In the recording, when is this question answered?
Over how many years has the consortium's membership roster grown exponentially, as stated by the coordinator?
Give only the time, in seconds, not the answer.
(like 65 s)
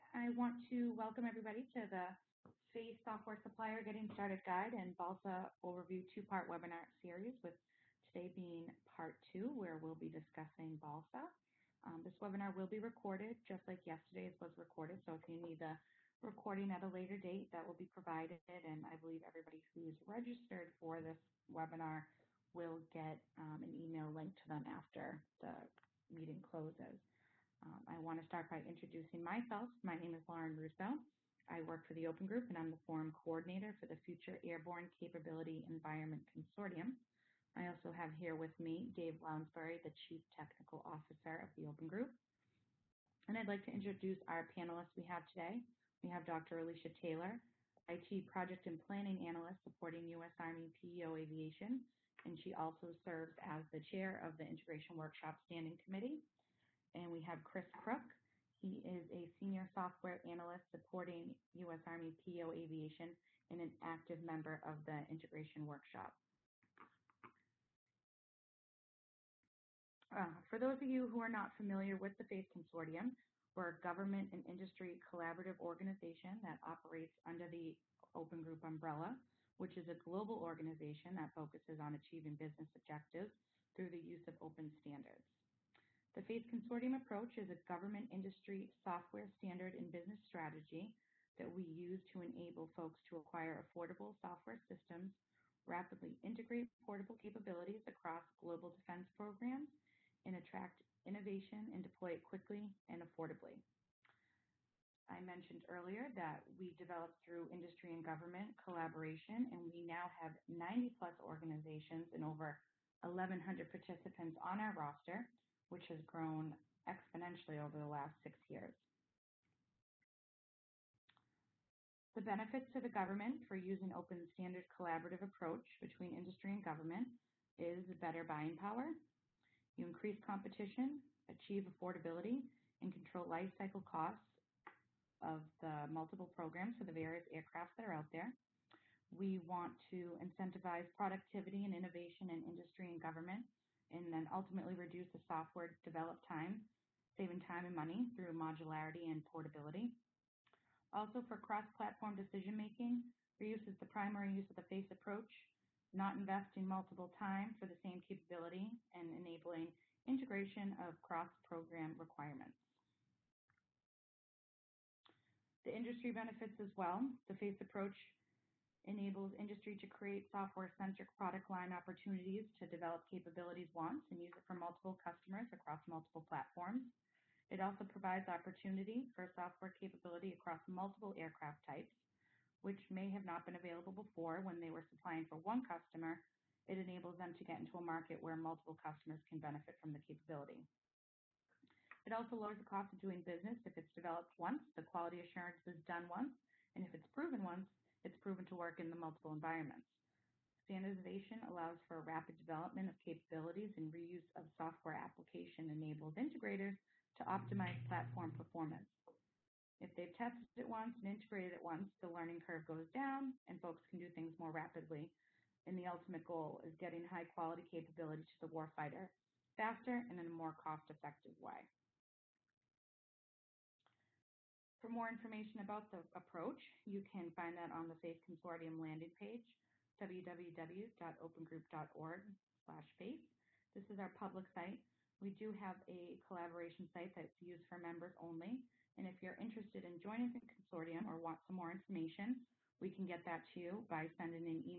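118 s.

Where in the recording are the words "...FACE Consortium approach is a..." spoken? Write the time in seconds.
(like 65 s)
86 s.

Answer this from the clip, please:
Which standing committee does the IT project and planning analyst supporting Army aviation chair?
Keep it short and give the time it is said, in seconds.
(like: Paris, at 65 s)
Integration Workshop Standing Committee, at 54 s.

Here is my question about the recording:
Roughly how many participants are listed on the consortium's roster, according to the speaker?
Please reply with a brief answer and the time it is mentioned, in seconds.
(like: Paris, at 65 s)
over 1,100, at 112 s.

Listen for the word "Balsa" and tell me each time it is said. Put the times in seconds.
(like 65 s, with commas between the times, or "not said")
4 s, 10 s.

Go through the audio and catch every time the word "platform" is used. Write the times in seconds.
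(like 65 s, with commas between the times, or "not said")
151 s, 176 s, 207 s.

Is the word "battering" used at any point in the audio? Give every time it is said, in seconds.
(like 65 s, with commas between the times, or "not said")
not said.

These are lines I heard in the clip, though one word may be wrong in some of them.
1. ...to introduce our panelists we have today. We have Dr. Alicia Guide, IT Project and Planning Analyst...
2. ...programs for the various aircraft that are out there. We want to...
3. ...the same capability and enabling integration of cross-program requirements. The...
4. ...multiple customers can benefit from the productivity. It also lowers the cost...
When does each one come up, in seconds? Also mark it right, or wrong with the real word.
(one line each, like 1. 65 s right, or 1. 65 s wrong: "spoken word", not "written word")
1. 43 s wrong: "Taylor", not "Guide"
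2. 136 s right
3. 157 s right
4. 188 s wrong: "capability", not "productivity".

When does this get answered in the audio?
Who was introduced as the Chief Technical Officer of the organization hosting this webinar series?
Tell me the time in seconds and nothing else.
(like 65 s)
38 s.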